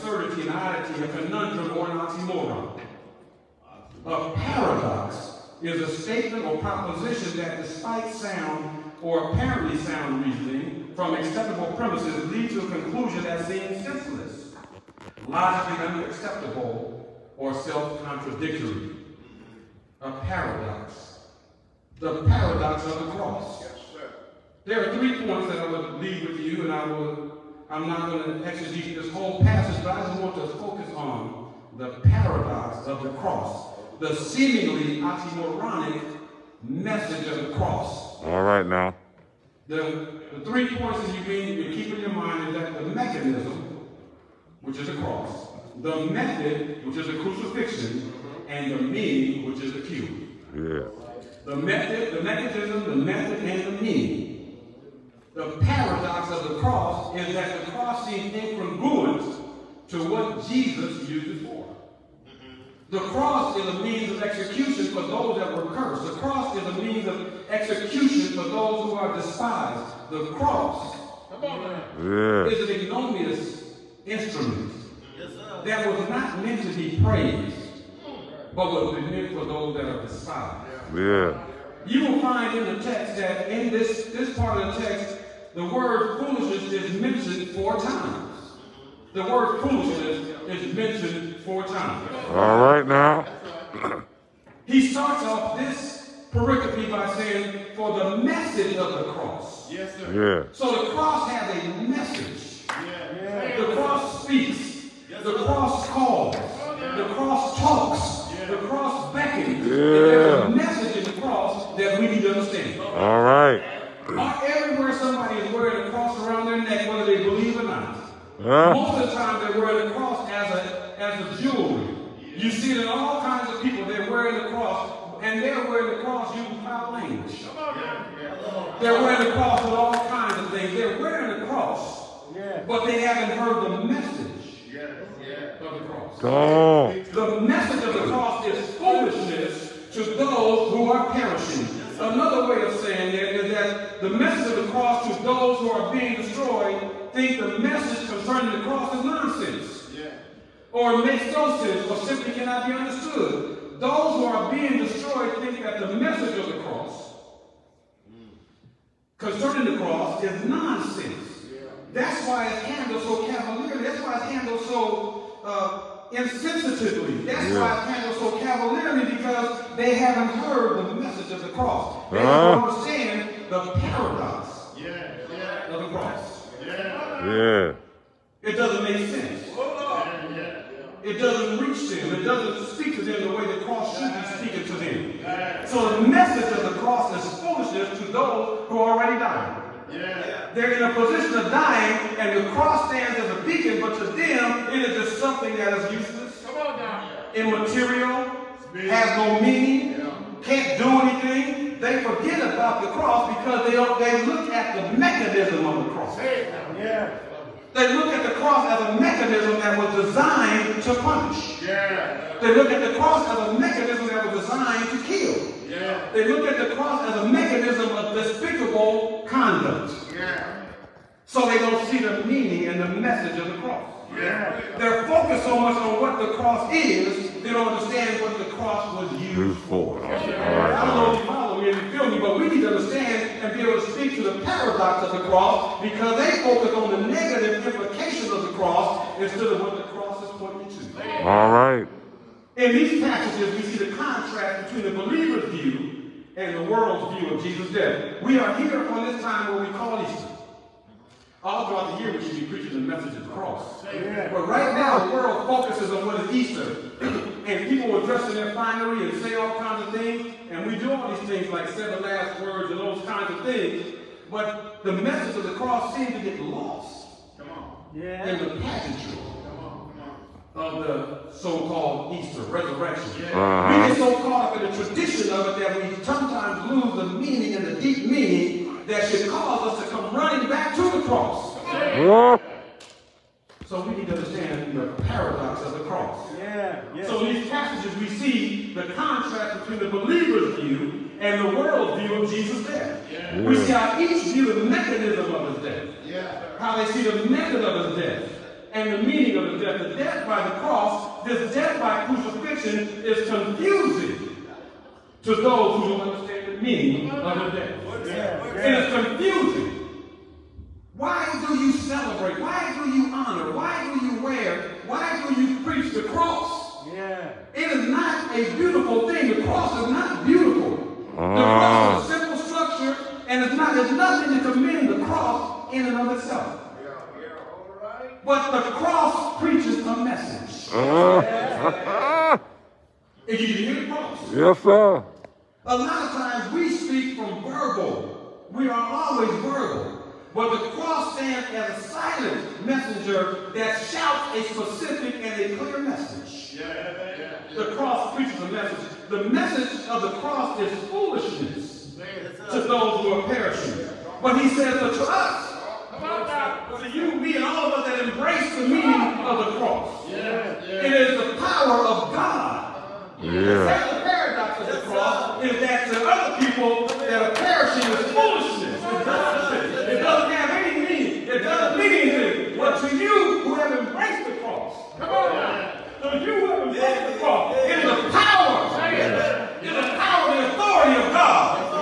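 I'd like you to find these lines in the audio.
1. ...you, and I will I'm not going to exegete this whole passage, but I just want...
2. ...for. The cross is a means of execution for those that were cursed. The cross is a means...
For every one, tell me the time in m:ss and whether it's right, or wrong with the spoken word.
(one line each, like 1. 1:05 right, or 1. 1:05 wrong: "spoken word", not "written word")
1. 0:26 right
2. 1:01 right.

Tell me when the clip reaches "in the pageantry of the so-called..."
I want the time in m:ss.
4:28.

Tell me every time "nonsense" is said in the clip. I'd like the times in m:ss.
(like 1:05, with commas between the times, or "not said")
2:29, 2:40.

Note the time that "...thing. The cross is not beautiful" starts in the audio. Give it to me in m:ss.
5:19.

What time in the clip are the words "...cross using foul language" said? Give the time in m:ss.
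2:06.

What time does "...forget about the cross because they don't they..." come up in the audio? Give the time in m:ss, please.
3:22.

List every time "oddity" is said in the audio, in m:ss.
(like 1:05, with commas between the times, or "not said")
0:00.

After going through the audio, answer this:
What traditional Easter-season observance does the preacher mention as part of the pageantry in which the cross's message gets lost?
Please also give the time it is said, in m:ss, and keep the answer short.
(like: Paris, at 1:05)
seven last words, at 4:21.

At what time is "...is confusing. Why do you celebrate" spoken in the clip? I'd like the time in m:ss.
5:08.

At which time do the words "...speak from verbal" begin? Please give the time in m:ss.
5:36.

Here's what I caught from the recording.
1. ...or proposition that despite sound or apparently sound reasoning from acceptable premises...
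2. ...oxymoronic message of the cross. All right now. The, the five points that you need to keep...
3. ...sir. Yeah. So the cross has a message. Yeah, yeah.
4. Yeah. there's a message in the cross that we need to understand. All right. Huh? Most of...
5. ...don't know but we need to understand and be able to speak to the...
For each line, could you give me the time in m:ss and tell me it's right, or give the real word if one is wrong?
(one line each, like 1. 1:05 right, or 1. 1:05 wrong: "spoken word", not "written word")
1. 0:06 right
2. 0:35 wrong: "three", not "five"
3. 1:39 right
4. 1:49 right
5. 3:50 right.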